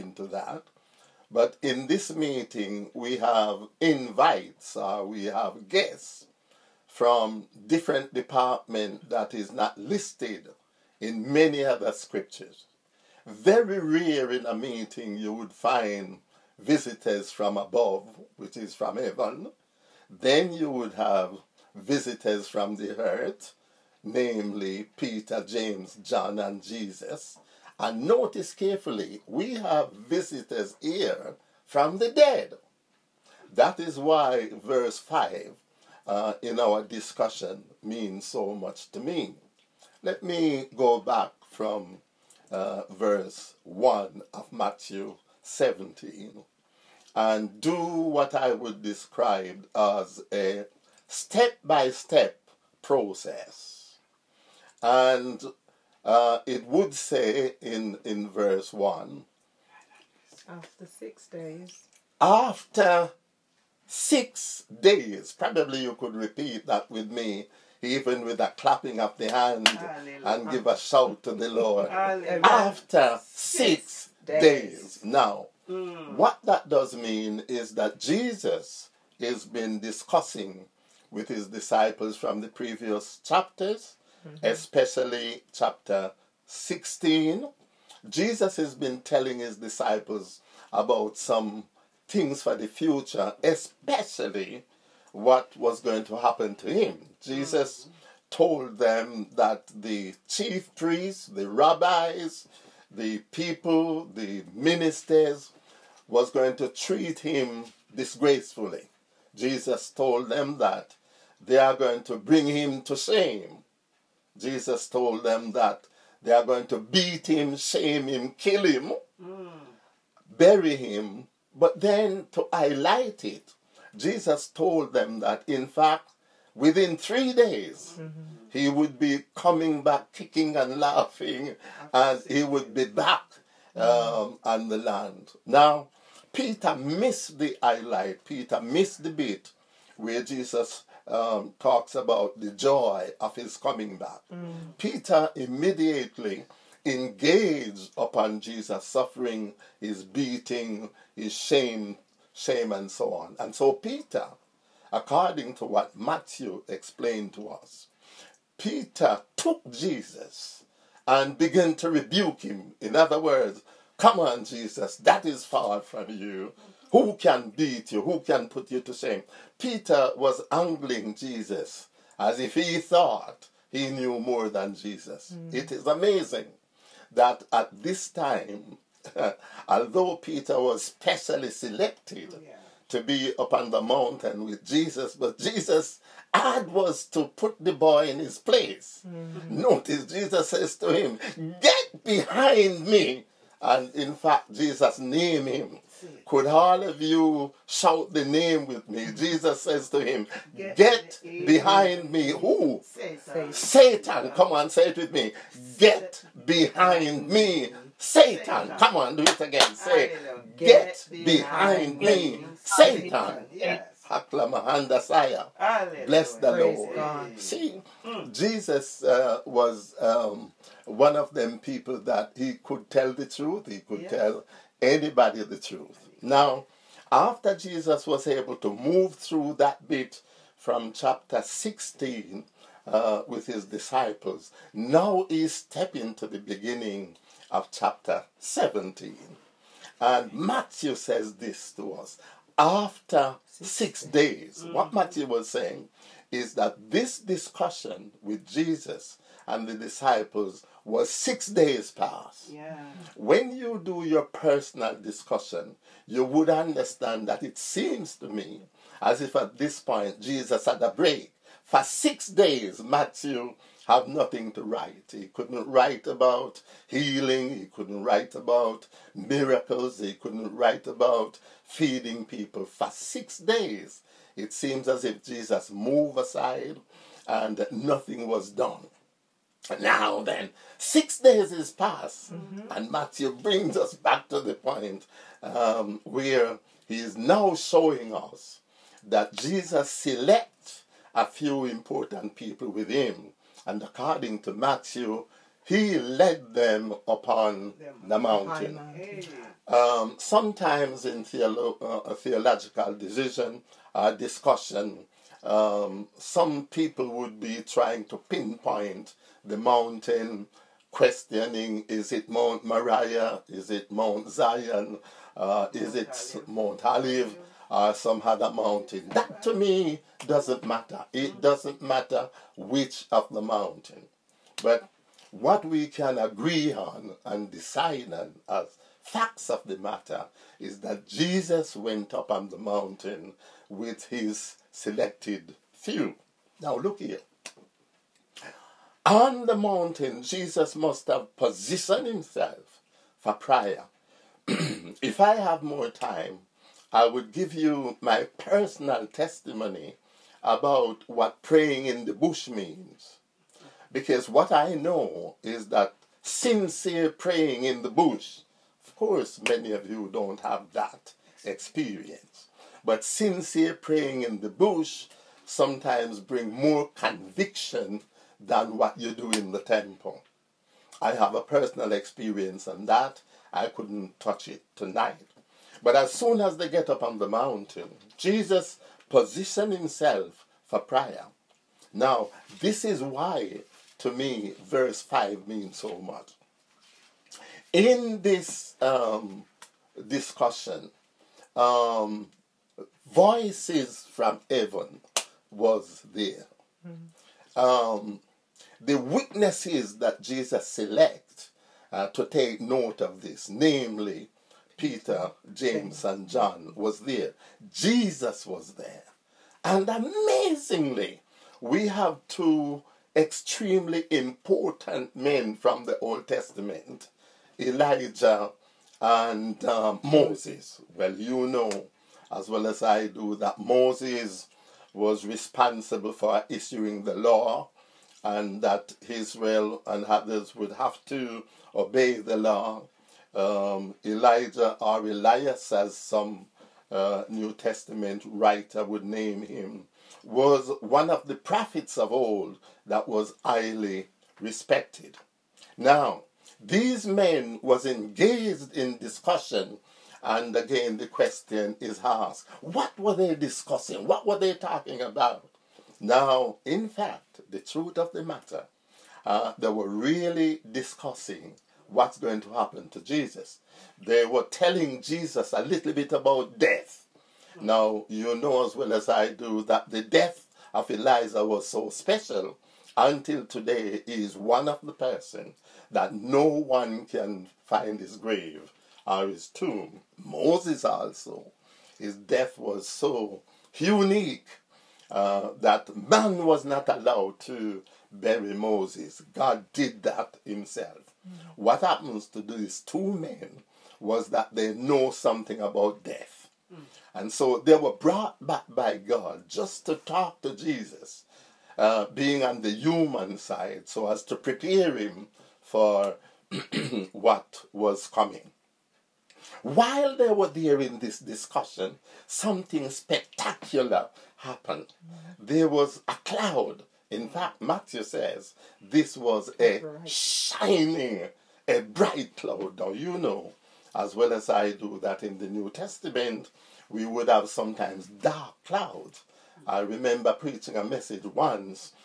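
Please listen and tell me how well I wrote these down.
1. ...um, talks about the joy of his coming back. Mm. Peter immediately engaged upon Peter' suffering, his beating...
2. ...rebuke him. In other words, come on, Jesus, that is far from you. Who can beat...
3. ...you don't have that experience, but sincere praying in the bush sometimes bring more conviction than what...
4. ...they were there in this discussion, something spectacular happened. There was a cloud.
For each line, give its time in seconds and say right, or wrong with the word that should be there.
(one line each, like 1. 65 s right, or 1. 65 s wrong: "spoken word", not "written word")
1. 141 s wrong: "Jesus", not "Peter"
2. 161 s right
3. 359 s right
4. 510 s right.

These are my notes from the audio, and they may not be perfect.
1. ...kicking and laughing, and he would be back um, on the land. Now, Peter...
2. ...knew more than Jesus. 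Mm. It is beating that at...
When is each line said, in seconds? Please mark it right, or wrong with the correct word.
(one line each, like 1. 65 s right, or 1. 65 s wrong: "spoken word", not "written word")
1. 130 s right
2. 173 s wrong: "amazing", not "beating".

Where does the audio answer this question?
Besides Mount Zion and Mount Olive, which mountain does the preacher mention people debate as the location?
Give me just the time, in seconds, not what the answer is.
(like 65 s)
312 s.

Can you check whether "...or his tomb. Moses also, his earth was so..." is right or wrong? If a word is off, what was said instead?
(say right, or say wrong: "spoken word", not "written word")
wrong: "death", not "earth".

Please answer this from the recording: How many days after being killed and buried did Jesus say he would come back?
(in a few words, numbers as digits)
3.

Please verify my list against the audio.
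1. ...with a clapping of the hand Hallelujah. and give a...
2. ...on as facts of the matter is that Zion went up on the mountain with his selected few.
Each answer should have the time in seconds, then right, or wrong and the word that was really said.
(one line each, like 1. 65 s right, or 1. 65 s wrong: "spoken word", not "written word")
1. 68 s right
2. 328 s wrong: "Jesus", not "Zion".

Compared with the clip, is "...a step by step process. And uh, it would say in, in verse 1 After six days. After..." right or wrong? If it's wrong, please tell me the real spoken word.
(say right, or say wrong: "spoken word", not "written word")
right.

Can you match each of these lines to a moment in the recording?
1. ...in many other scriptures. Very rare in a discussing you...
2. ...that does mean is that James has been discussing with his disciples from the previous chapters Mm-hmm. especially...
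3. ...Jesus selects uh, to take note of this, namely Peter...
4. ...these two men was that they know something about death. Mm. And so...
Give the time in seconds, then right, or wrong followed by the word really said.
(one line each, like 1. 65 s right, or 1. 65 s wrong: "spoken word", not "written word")
1. 10 s wrong: "meeting", not "discussing"
2. 76 s wrong: "Jesus", not "James"
3. 400 s right
4. 492 s right.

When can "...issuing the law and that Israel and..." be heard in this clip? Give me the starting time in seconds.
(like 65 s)
426 s.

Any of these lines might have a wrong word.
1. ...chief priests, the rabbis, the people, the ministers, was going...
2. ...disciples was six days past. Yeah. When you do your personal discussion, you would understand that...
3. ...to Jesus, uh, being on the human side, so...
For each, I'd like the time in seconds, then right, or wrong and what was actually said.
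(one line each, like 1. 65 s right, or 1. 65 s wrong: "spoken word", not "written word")
1. 100 s right
2. 249 s right
3. 500 s right.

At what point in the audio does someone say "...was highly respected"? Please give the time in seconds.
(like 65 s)
443 s.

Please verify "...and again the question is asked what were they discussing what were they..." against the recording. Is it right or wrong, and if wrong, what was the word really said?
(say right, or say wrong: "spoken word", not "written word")
right.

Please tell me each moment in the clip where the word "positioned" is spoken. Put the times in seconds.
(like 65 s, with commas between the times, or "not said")
341 s, 379 s.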